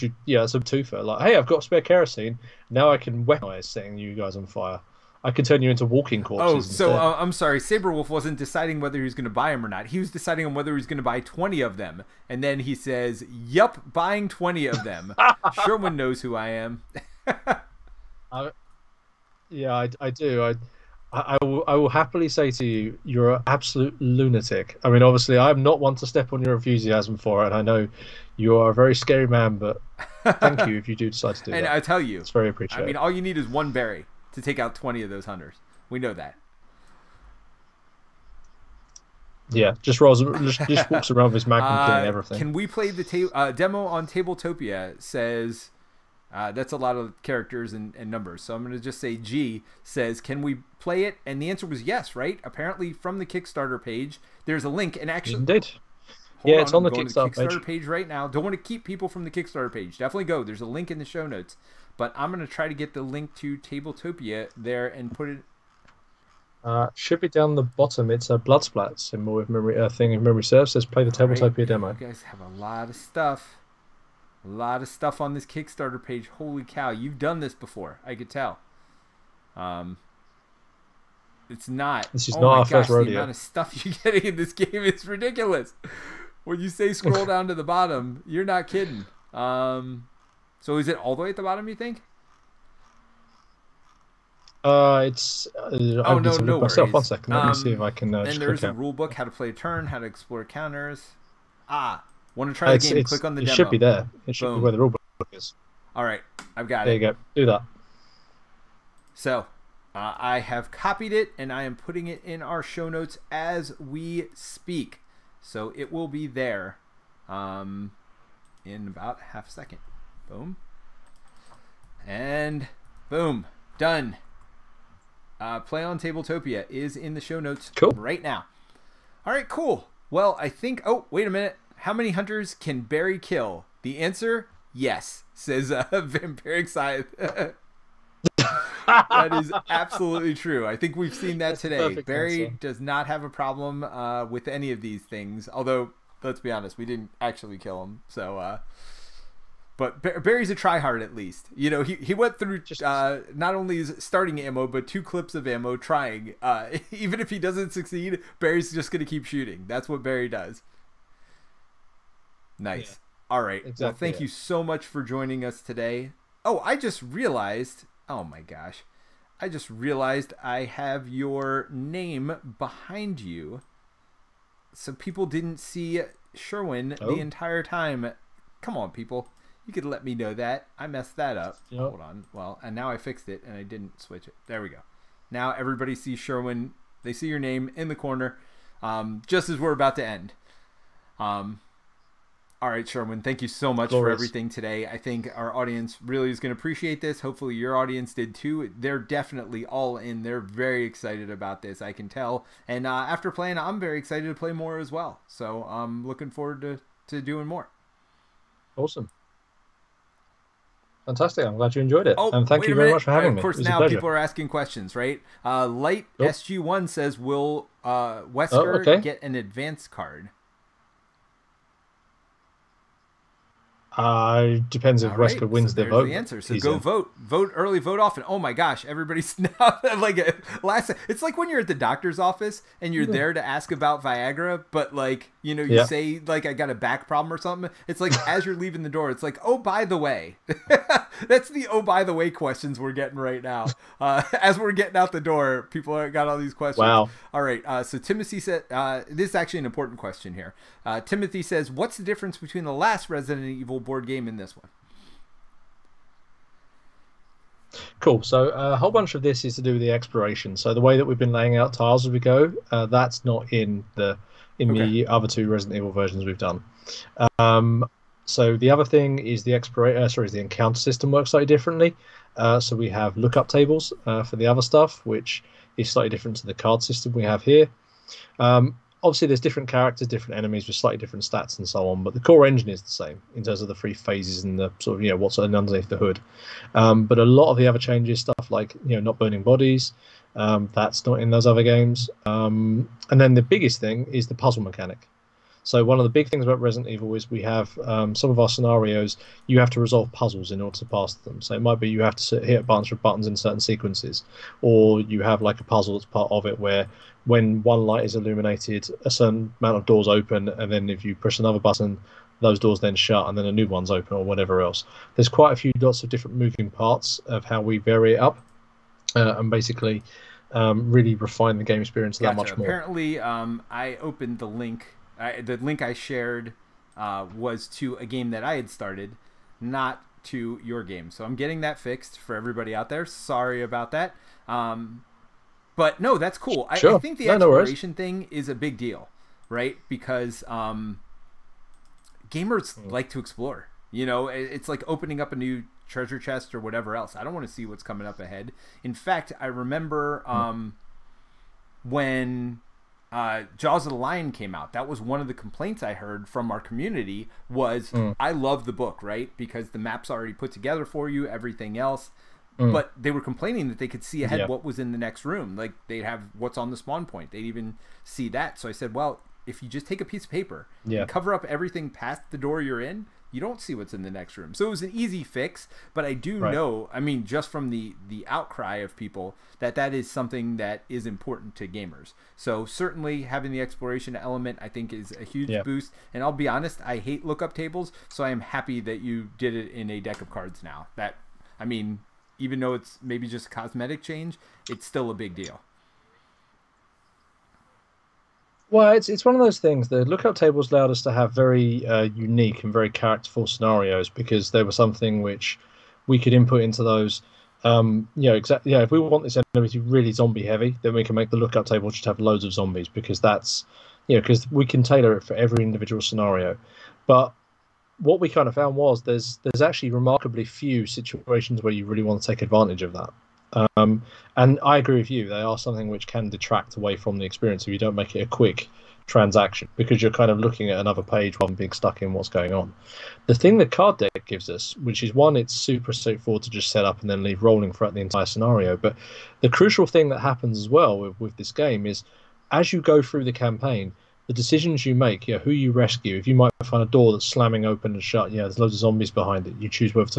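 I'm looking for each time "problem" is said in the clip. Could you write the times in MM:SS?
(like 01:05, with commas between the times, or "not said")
02:23, 03:57.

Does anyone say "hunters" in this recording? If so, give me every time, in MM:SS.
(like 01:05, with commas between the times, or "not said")
00:35, 02:12.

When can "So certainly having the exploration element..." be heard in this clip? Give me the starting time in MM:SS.
06:22.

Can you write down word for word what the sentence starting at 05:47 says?
I don't want to see what's coming up ahead.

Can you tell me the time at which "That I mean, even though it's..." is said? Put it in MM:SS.
06:30.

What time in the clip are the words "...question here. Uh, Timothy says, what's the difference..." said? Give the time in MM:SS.
04:09.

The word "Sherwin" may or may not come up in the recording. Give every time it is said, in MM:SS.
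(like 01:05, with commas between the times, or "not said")
00:15, 02:56, 03:06, 03:12.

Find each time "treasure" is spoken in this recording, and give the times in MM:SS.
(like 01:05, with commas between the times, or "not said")
05:45.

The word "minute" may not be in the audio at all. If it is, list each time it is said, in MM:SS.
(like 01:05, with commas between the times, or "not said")
02:11, 03:32.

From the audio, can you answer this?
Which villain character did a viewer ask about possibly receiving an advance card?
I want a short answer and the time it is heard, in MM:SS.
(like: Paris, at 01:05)
Wesker, at 03:38.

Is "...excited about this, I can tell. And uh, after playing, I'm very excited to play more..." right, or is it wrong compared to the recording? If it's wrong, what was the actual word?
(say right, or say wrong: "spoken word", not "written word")
right.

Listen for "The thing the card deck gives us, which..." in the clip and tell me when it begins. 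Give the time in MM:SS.
07:13.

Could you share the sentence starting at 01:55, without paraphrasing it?
So it will be there um, in about half a second.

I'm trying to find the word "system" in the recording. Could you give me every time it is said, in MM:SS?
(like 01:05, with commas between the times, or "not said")
04:30, 04:36.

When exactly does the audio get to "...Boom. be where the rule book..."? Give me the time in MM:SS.
01:44.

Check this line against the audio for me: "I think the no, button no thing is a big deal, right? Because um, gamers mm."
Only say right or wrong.
wrong.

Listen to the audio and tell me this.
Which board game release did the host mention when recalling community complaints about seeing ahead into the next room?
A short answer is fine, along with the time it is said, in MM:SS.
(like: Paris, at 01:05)
Jaws of the Lion, at 05:53.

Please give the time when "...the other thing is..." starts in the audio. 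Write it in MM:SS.
04:28.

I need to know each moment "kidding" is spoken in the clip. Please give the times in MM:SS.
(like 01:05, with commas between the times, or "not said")
01:28.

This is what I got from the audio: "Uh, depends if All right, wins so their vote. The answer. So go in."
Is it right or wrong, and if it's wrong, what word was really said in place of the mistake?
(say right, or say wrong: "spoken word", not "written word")
right.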